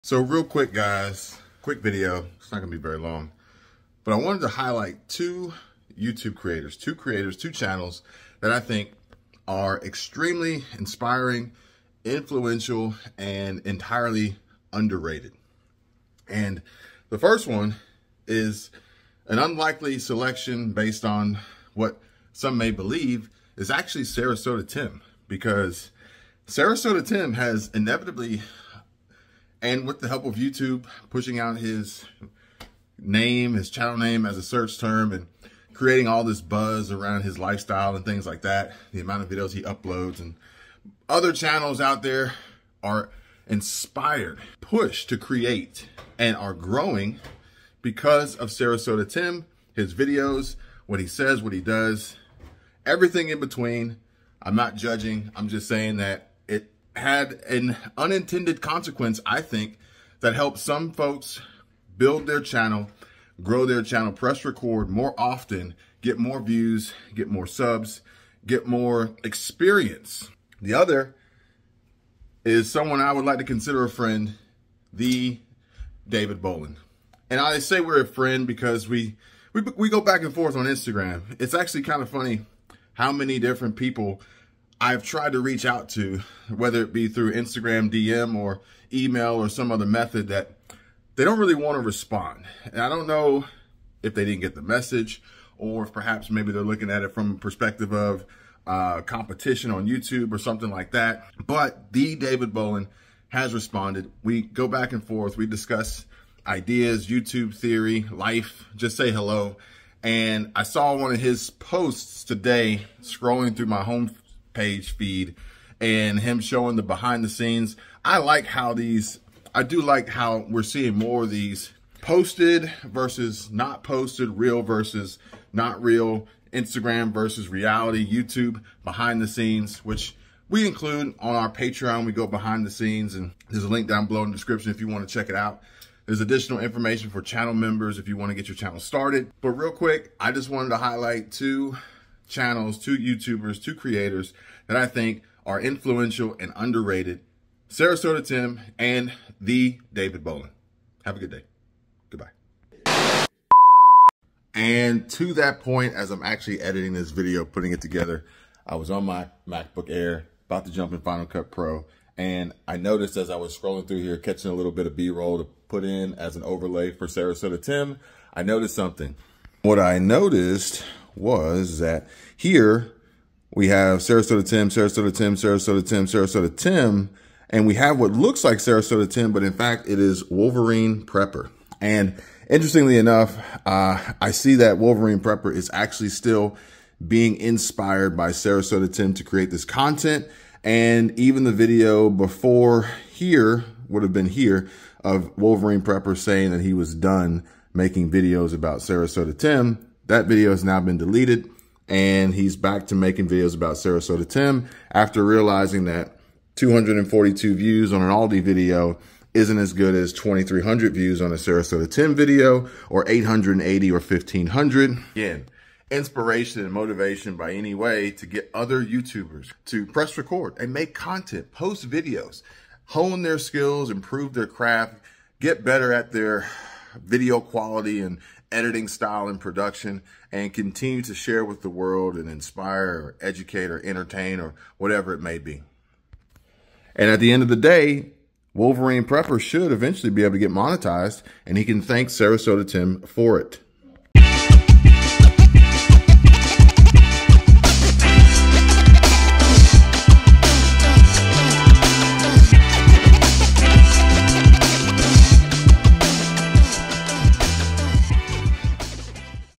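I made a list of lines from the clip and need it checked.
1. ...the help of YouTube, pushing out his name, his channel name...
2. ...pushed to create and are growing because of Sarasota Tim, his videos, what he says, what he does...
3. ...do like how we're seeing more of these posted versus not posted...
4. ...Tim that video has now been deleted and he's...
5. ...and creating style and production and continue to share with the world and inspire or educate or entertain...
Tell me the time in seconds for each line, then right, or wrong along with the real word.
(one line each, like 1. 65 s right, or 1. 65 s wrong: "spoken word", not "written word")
1. 29 s right
2. 44 s right
3. 119 s right
4. 199 s right
5. 228 s wrong: "editing", not "creating".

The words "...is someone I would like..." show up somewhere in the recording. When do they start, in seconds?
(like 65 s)
72 s.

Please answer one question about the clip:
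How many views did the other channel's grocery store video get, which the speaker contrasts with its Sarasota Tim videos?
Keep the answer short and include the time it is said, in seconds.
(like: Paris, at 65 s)
242, at 206 s.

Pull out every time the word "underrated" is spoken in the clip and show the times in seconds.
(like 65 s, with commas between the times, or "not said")
14 s, 146 s.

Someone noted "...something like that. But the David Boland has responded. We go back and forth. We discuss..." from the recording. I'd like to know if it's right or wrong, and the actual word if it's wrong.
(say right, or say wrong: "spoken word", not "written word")
right.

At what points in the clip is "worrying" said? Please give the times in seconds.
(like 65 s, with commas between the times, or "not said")
not said.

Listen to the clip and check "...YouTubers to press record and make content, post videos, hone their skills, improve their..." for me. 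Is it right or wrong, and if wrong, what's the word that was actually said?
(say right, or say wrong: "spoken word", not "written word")
right.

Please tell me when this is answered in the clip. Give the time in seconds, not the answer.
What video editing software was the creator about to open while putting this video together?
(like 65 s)
161 s.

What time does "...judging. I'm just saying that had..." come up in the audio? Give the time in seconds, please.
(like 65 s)
54 s.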